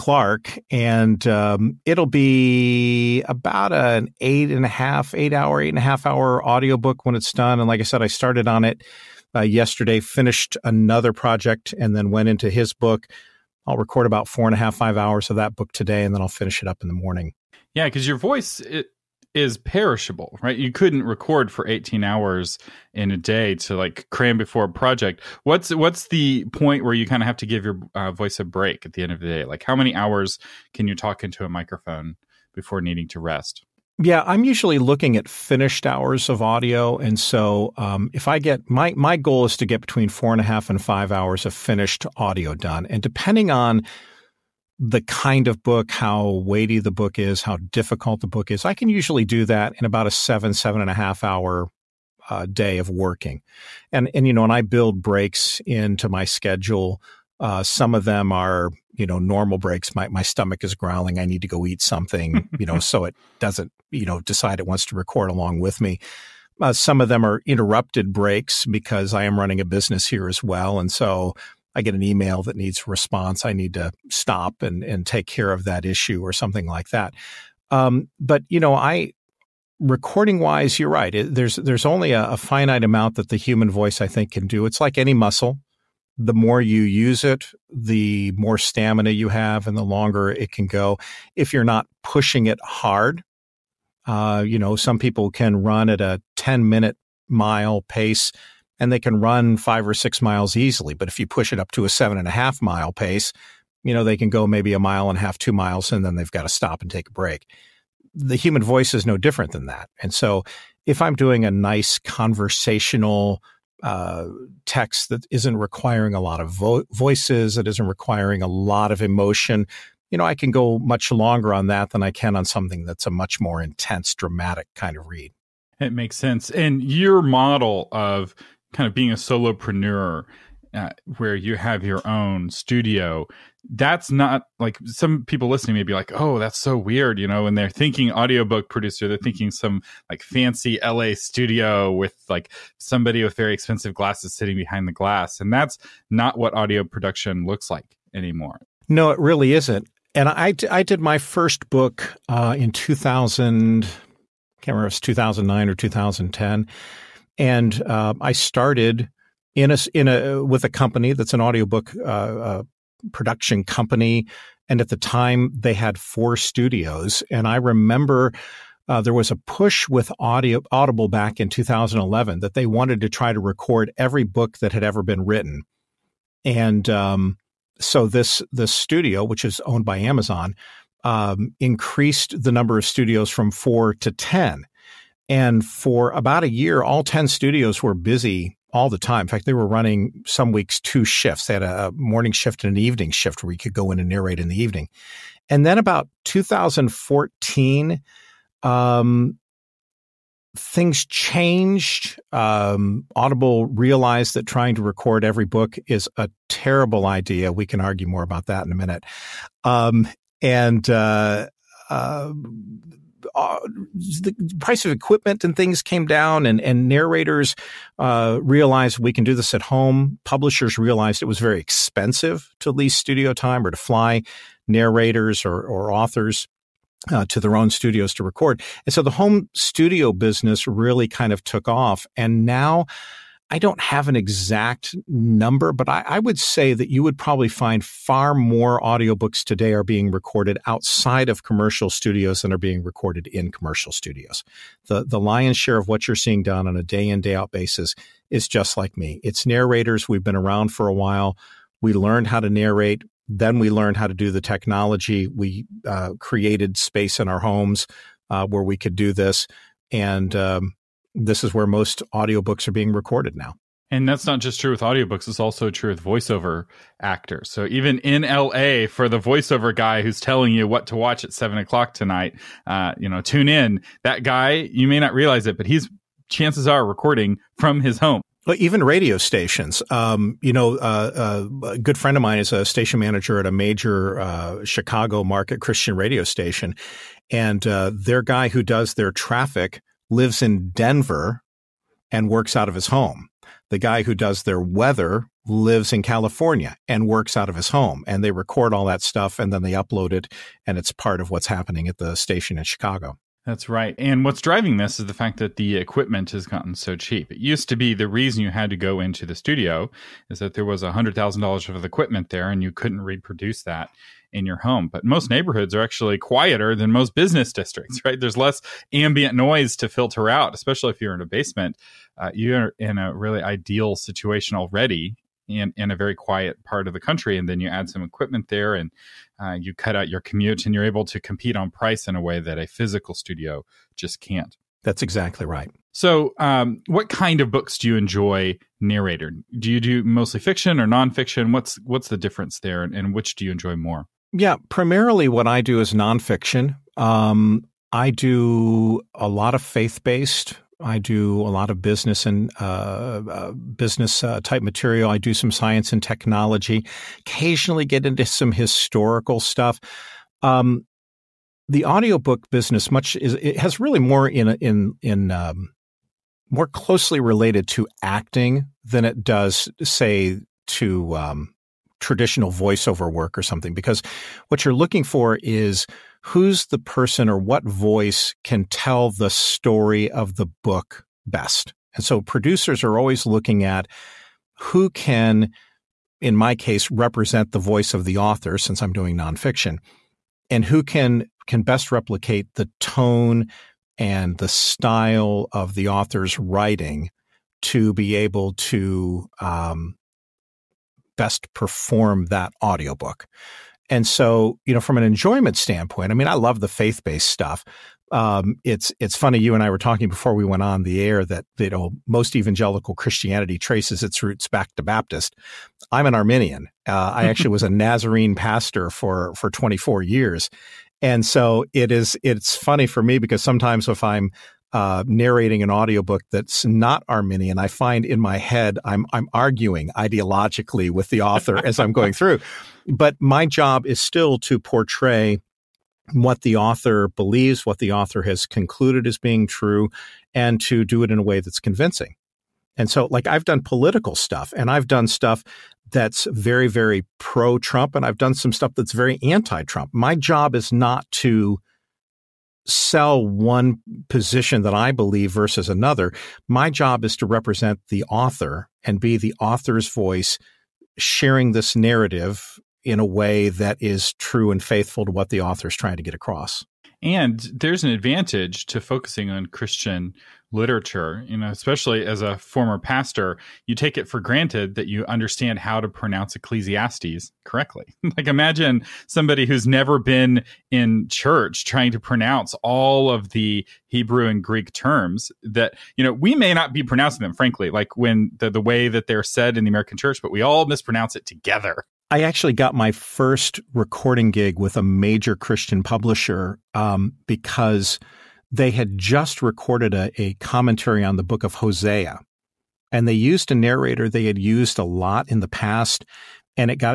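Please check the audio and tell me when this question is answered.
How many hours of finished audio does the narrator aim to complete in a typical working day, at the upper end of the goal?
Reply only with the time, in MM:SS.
00:40.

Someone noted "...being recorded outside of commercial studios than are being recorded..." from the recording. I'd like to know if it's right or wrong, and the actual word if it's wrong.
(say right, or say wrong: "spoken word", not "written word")
right.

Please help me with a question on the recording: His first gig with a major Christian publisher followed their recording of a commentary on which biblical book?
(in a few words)
Hosea.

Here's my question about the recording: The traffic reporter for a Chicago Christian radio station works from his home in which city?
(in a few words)
Denver.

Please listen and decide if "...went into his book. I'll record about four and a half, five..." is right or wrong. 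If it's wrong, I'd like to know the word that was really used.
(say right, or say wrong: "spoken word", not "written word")
right.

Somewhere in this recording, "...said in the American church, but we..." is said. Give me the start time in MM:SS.
08:09.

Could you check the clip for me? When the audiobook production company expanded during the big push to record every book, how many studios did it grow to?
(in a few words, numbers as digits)
10.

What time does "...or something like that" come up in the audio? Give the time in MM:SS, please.
01:16.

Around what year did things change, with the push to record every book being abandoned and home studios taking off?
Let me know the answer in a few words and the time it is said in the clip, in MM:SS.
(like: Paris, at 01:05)
2014, at 03:16.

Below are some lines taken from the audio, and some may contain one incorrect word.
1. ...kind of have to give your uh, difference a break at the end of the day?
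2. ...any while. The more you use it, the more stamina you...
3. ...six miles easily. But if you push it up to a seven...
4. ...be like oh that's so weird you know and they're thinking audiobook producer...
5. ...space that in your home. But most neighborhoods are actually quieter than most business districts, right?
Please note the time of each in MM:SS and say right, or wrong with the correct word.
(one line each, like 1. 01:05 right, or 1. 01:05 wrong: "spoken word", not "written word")
1. 00:27 wrong: "voice", not "difference"
2. 01:24 wrong: "muscle", not "while"
3. 01:39 right
4. 02:15 right
5. 05:13 wrong: "reproduce", not "space".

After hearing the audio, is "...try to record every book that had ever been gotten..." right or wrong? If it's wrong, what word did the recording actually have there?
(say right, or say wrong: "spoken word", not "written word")
wrong: "written", not "gotten".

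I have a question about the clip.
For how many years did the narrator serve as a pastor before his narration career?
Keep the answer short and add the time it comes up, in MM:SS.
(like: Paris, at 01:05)
24 years, at 06:59.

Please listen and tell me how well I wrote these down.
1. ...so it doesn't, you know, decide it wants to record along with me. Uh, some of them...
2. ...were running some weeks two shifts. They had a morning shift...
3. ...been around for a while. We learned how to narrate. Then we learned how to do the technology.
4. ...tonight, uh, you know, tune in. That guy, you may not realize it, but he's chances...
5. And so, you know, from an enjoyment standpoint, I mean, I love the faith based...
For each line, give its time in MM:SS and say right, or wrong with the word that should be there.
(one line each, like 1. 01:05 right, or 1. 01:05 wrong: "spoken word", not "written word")
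1. 01:02 right
2. 03:09 right
3. 04:10 right
4. 04:31 right
5. 06:43 right.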